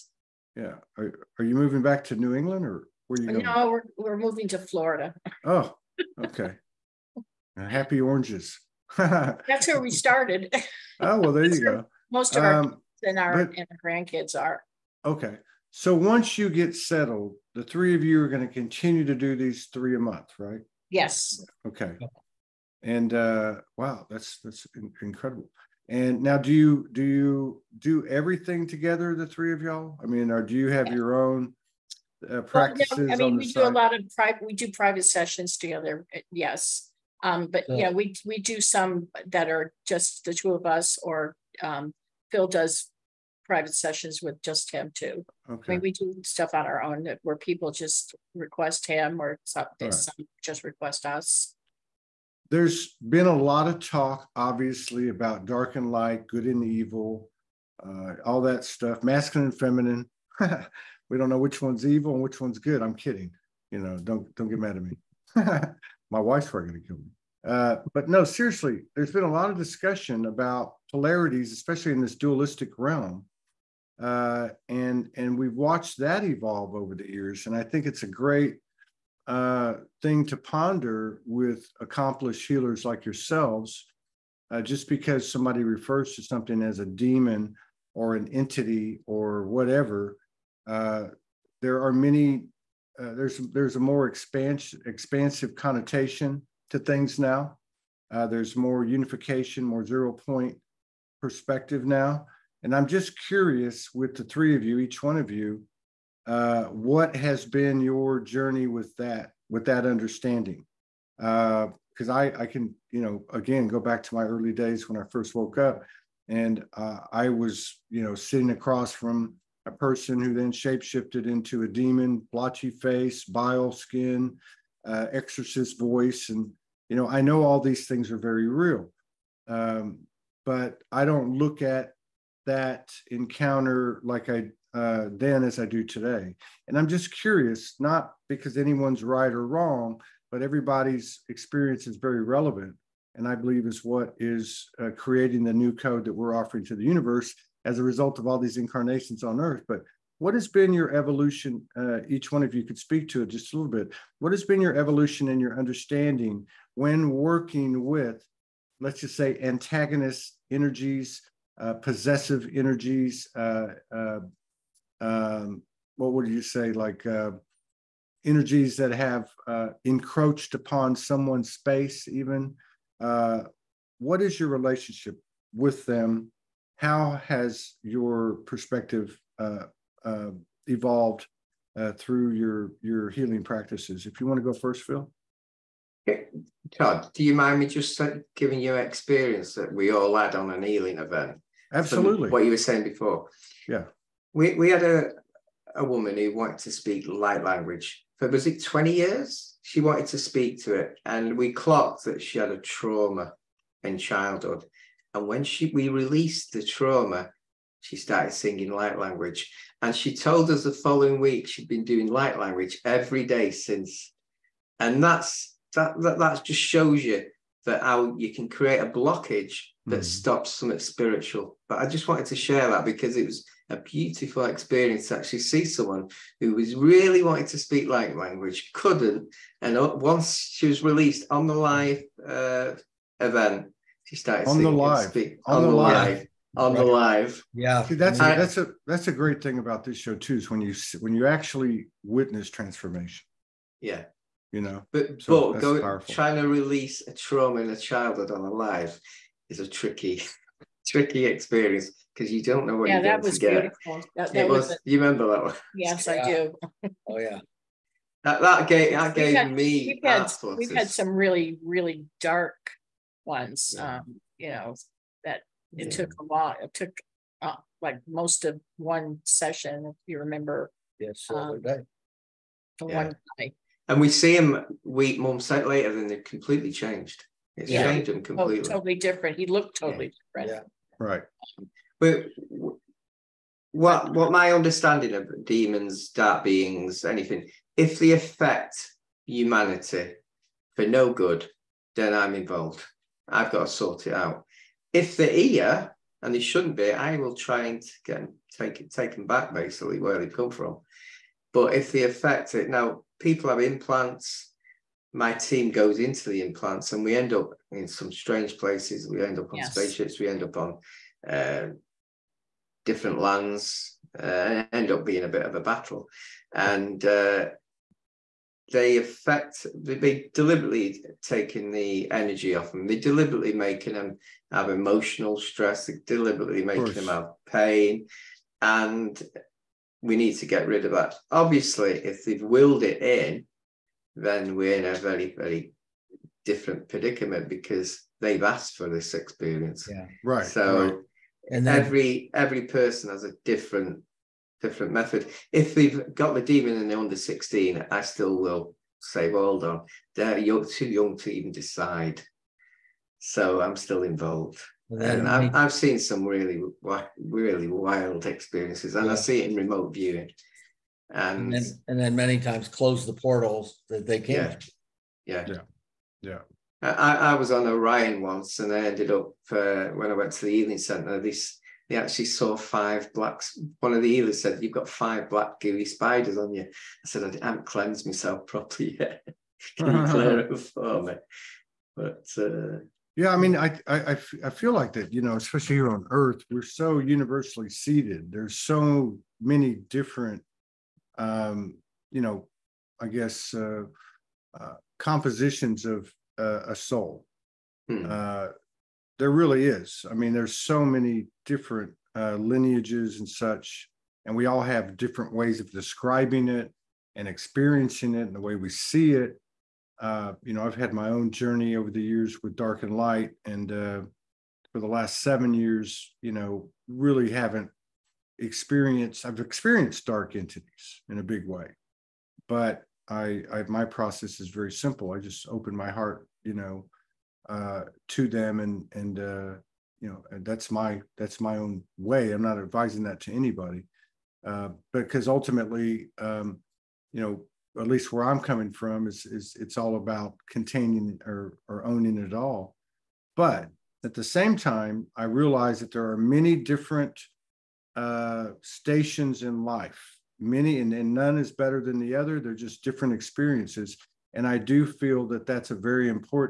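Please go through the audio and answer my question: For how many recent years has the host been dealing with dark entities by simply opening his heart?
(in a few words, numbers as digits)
7.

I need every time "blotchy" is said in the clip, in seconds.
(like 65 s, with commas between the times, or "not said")
122 s.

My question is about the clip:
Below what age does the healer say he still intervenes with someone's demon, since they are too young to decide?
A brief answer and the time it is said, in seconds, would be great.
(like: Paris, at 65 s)
16, at 347 s.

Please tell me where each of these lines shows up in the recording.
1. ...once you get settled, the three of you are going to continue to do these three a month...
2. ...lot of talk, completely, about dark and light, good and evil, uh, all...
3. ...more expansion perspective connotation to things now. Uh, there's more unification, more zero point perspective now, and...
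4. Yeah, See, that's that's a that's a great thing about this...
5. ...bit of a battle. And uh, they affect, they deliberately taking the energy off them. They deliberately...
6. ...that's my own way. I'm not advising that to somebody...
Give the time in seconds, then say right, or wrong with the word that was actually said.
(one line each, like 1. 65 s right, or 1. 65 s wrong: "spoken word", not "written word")
1. 15 s right
2. 53 s wrong: "obviously", not "completely"
3. 93 s wrong: "expansive", not "perspective"
4. 237 s right
5. 315 s right
6. 431 s wrong: "anybody", not "somebody".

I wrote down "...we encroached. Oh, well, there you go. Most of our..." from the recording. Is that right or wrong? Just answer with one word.
wrong.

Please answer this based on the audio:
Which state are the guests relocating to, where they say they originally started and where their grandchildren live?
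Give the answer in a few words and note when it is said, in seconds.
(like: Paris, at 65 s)
Florida, at 4 s.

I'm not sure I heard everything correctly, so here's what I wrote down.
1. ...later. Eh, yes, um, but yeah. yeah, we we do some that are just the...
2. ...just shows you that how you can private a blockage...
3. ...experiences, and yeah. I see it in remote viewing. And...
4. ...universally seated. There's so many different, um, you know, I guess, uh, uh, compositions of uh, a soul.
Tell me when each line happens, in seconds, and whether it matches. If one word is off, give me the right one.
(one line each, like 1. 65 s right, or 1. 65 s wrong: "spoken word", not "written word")
1. 35 s wrong: "together", not "later"
2. 216 s wrong: "create", not "private"
3. 358 s right
4. 386 s right.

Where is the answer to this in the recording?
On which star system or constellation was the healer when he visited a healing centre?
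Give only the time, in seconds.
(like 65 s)
367 s.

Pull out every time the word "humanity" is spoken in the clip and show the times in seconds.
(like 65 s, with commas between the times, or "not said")
289 s.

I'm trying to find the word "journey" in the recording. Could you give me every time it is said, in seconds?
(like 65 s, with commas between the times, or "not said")
108 s, 411 s.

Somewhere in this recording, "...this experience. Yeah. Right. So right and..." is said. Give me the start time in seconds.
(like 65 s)
338 s.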